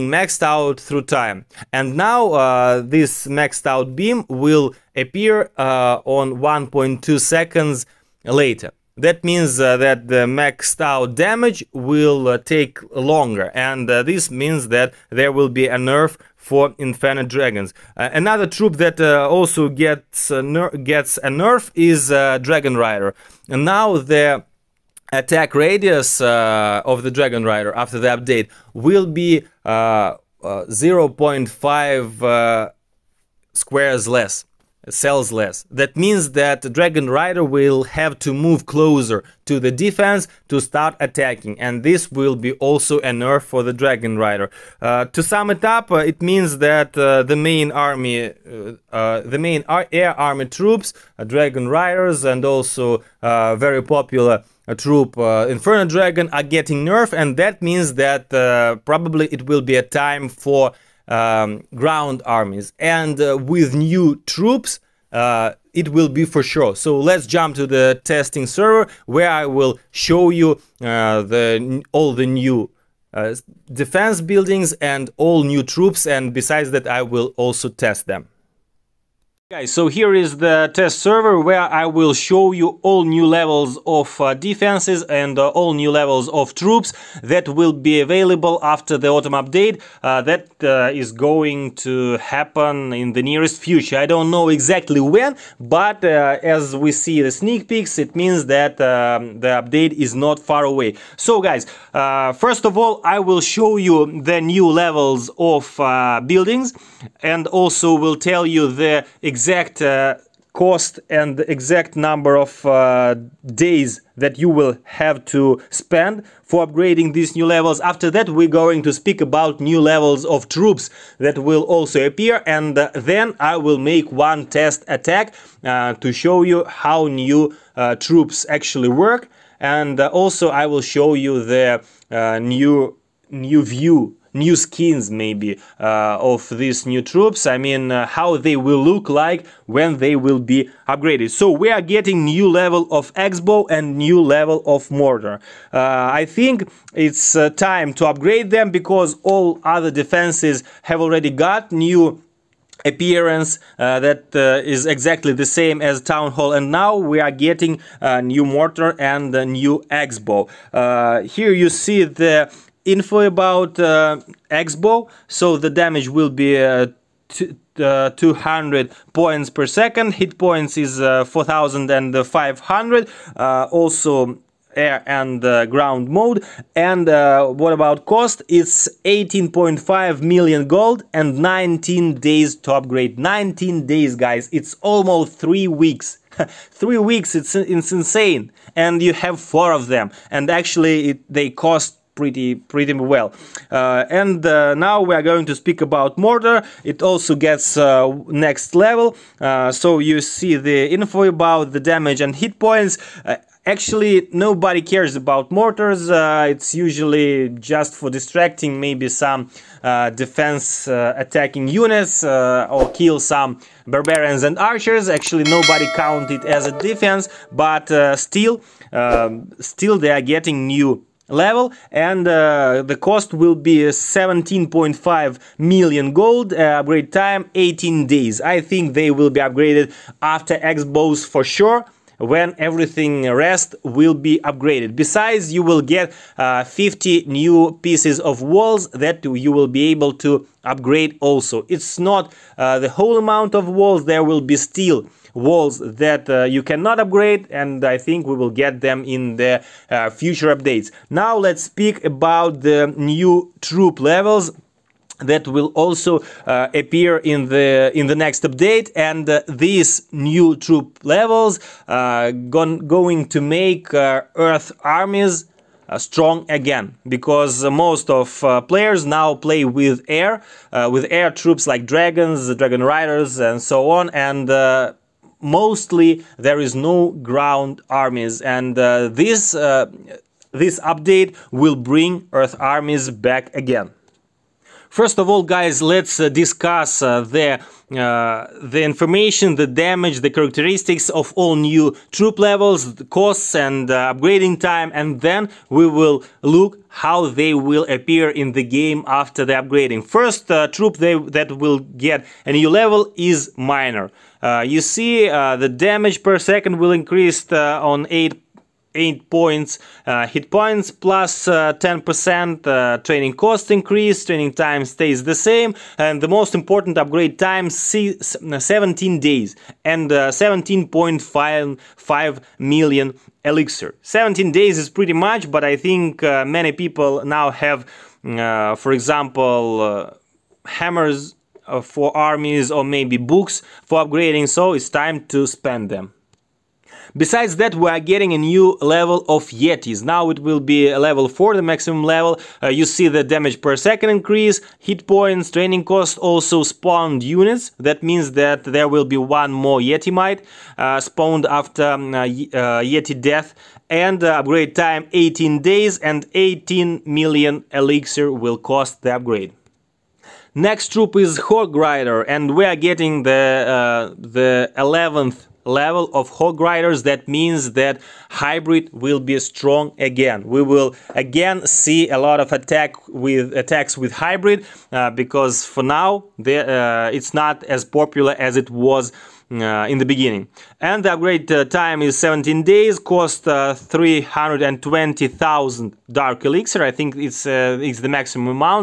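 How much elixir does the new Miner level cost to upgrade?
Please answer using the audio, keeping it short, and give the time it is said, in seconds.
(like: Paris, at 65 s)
17.5 million elixir, at 320 s.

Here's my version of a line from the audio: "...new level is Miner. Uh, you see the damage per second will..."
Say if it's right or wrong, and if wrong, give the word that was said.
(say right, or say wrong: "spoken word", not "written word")
right.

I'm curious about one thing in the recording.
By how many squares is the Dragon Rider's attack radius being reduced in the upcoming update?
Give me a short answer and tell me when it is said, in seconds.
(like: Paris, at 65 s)
0.5 squares, at 30 s.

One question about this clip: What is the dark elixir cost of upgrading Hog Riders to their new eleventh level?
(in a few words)
320,000 dark elixir.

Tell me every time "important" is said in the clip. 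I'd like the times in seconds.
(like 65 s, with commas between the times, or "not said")
316 s.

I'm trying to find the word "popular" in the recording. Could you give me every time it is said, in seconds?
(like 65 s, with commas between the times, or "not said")
53 s, 377 s.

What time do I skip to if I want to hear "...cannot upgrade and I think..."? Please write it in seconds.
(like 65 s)
246 s.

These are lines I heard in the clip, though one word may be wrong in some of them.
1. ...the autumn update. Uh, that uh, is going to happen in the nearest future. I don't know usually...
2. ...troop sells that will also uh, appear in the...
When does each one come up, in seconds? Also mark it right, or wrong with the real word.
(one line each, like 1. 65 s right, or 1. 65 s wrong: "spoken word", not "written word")
1. 88 s wrong: "exactly", not "usually"
2. 253 s wrong: "levels", not "sells".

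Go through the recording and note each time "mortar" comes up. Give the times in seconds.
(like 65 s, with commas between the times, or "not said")
144 s, 158 s, 196 s, 205 s.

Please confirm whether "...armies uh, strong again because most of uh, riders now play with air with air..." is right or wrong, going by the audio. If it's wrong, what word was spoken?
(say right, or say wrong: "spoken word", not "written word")
wrong: "players", not "riders".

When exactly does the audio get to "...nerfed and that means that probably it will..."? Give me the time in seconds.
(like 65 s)
56 s.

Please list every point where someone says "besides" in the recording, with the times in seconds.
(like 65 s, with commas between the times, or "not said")
76 s, 234 s, 337 s.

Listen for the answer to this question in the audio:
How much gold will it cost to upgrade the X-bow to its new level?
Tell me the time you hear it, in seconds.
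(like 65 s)
179 s.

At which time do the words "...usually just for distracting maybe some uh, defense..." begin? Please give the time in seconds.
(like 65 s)
206 s.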